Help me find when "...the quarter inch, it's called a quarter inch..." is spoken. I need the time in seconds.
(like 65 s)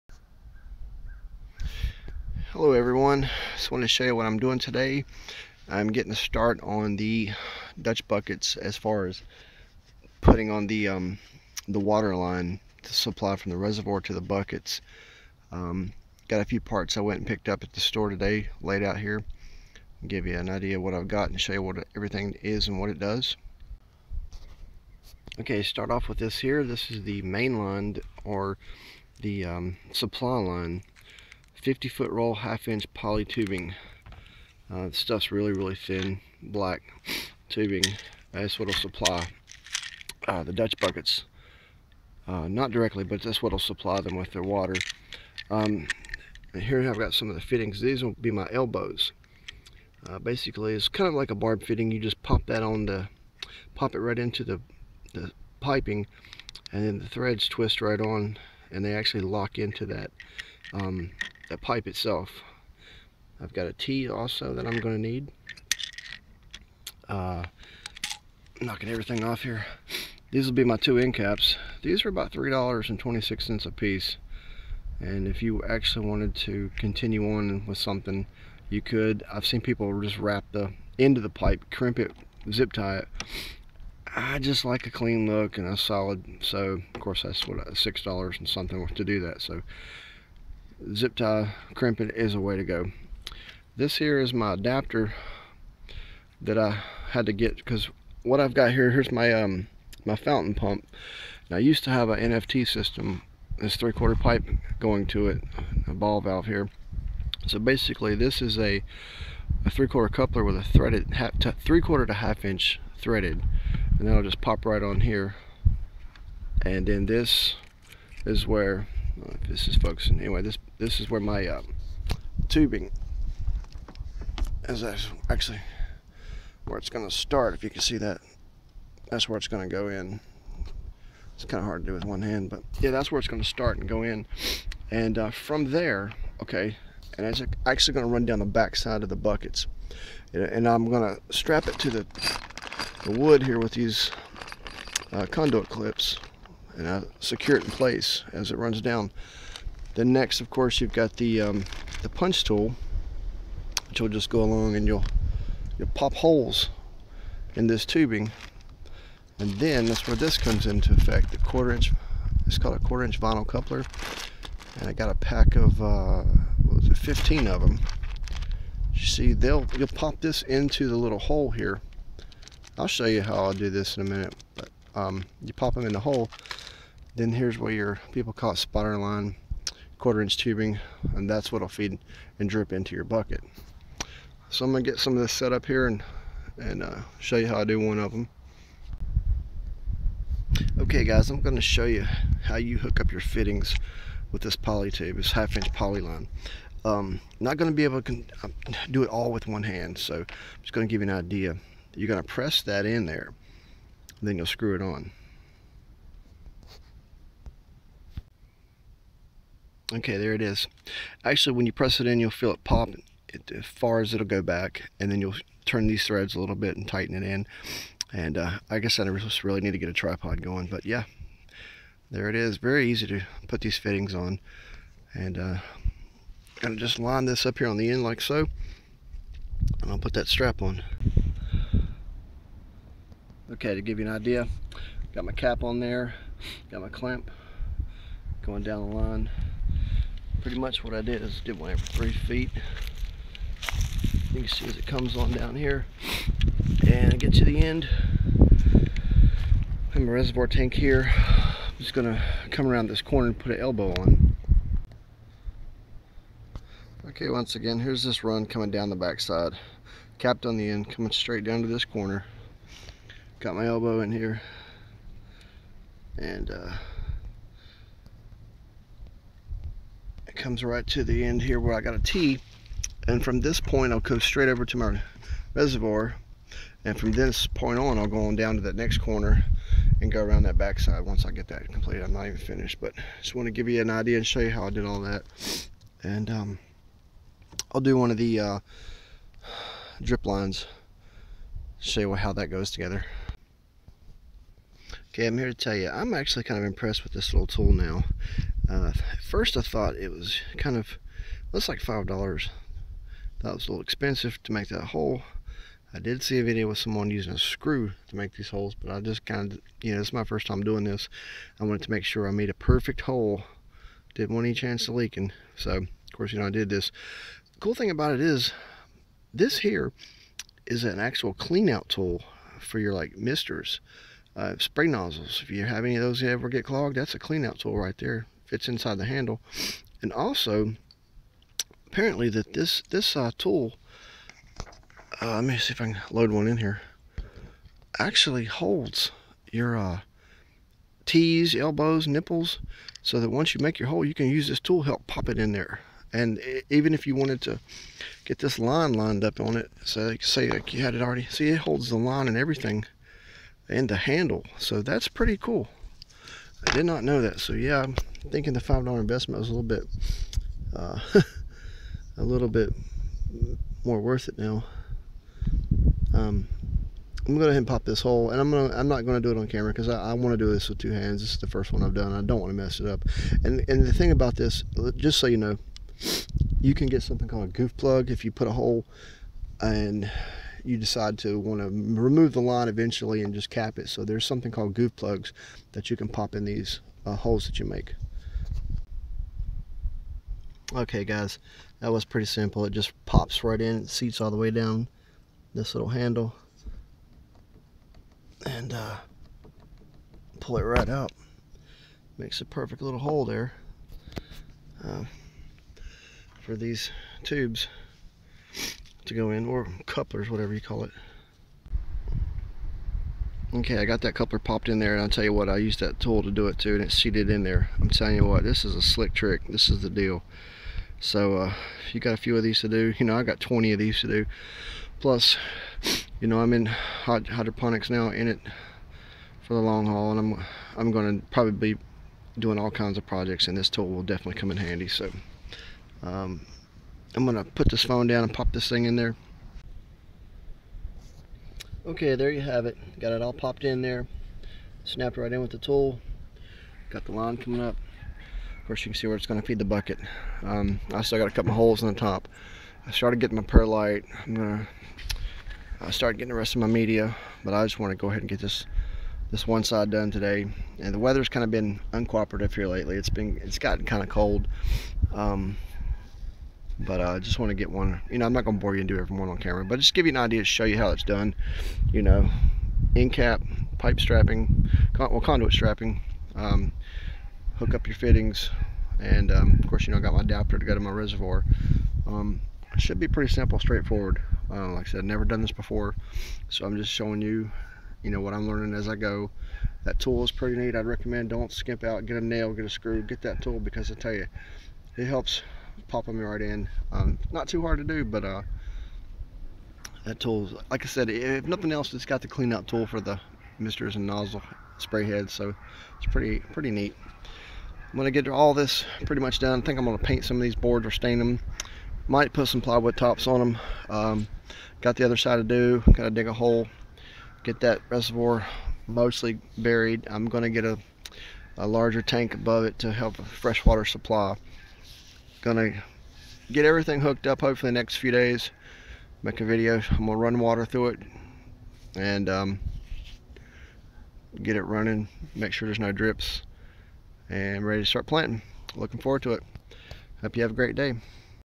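161 s.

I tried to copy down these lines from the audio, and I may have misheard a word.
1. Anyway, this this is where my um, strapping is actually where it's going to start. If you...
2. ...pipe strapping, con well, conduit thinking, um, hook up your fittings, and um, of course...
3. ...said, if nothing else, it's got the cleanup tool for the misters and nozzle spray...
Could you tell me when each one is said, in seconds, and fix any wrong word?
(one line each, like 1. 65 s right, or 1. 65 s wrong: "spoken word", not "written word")
1. 120 s wrong: "tubing", not "strapping"
2. 473 s wrong: "strapping", not "thinking"
3. 500 s right.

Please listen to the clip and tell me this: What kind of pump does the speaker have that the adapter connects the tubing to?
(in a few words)
fountain pump.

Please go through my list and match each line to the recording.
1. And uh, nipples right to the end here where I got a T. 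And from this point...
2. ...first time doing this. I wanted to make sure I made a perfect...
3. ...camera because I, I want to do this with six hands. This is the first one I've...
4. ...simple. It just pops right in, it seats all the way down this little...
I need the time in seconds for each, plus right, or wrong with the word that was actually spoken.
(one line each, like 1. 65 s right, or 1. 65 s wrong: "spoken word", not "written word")
1. 266 s wrong: "comes", not "nipples"
2. 310 s right
3. 369 s wrong: "two", not "six"
4. 392 s right.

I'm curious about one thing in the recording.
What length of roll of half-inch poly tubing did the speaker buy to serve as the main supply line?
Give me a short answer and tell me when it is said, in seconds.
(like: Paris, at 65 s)
50 foot, at 31 s.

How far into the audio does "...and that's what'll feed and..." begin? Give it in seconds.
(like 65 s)
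181 s.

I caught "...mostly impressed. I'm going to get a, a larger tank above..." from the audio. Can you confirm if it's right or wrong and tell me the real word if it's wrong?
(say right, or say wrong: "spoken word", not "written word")
wrong: "buried", not "impressed".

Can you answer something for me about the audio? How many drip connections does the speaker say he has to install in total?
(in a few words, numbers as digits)
20.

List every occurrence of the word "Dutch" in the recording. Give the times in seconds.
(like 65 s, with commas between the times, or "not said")
7 s, 40 s.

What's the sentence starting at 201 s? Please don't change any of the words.
You're gonna press that in there, then you'll screw it on.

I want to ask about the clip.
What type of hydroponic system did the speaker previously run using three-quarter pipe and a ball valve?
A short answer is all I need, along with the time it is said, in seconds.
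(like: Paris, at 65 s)
NFT system, at 102 s.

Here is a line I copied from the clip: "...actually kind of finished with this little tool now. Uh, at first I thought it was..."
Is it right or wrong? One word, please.
wrong.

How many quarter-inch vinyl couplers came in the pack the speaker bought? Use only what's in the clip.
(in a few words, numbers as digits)
15.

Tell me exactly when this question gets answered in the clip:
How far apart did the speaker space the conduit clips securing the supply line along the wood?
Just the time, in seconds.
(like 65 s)
241 s.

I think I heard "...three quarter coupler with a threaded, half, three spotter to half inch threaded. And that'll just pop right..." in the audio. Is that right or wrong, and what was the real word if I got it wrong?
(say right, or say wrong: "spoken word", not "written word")
wrong: "quarter", not "spotter".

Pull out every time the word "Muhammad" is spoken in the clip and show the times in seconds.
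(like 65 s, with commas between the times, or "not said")
not said.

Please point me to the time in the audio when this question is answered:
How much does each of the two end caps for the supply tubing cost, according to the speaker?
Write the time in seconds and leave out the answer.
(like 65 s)
72 s.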